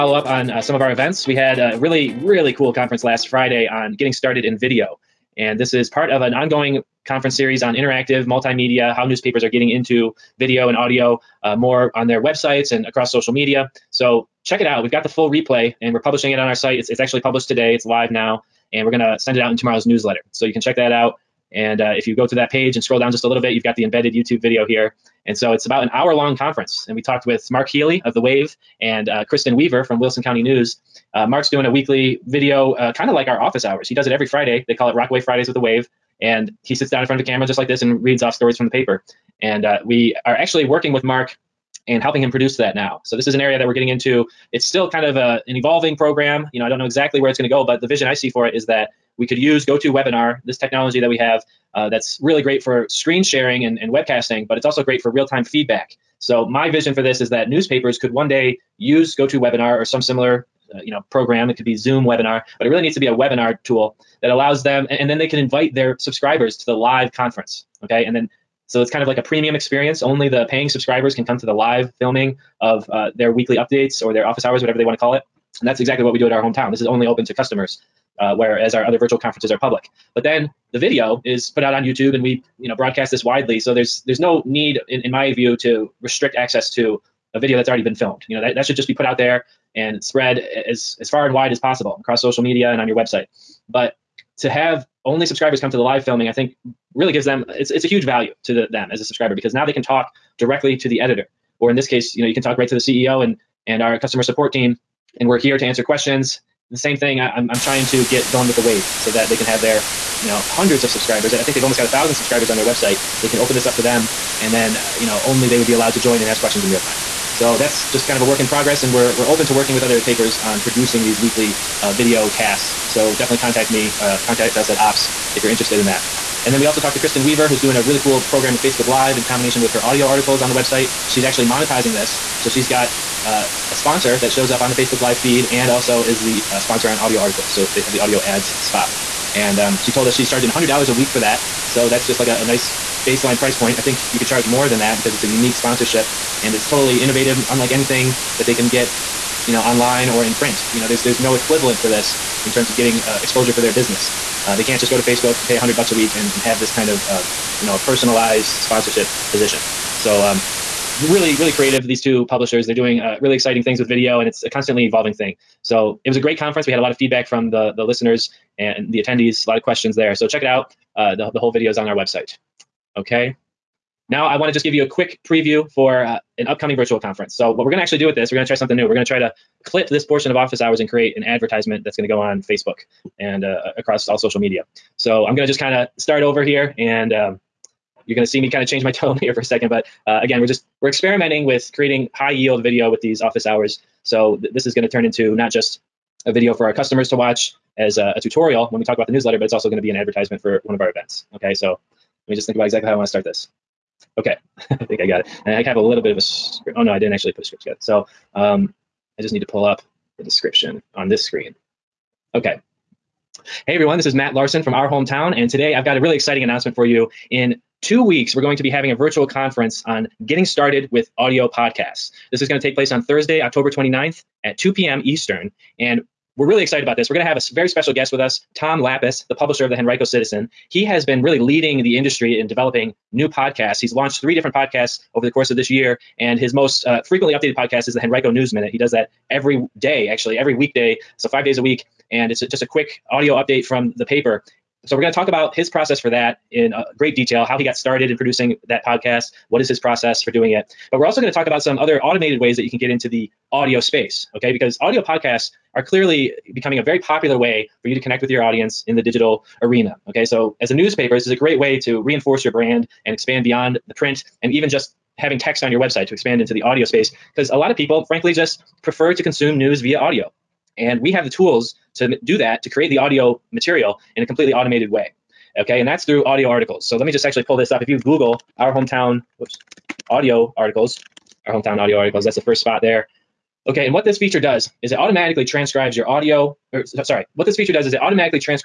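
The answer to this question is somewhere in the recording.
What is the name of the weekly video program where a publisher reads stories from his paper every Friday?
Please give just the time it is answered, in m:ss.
0:34.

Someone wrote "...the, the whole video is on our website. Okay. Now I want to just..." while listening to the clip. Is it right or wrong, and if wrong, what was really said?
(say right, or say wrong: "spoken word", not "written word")
right.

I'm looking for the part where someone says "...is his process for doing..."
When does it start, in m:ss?
4:09.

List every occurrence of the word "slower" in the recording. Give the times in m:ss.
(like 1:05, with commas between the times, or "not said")
not said.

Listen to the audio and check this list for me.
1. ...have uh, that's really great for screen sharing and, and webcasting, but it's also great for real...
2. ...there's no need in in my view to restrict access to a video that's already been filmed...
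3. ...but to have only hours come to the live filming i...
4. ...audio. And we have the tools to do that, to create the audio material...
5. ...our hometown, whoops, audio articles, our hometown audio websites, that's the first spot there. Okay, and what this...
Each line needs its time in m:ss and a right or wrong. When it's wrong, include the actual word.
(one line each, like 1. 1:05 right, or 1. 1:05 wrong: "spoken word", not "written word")
1. 0:51 right
2. 1:24 right
3. 1:33 wrong: "subscribers", not "hours"
4. 4:29 right
5. 4:38 wrong: "articles", not "websites".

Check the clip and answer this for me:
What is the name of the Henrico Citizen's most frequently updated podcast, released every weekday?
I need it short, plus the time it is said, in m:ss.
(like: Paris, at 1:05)
Henrico News Minute, at 3:58.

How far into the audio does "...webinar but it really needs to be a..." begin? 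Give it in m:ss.
1:02.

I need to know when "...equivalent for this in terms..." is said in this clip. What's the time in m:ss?
2:31.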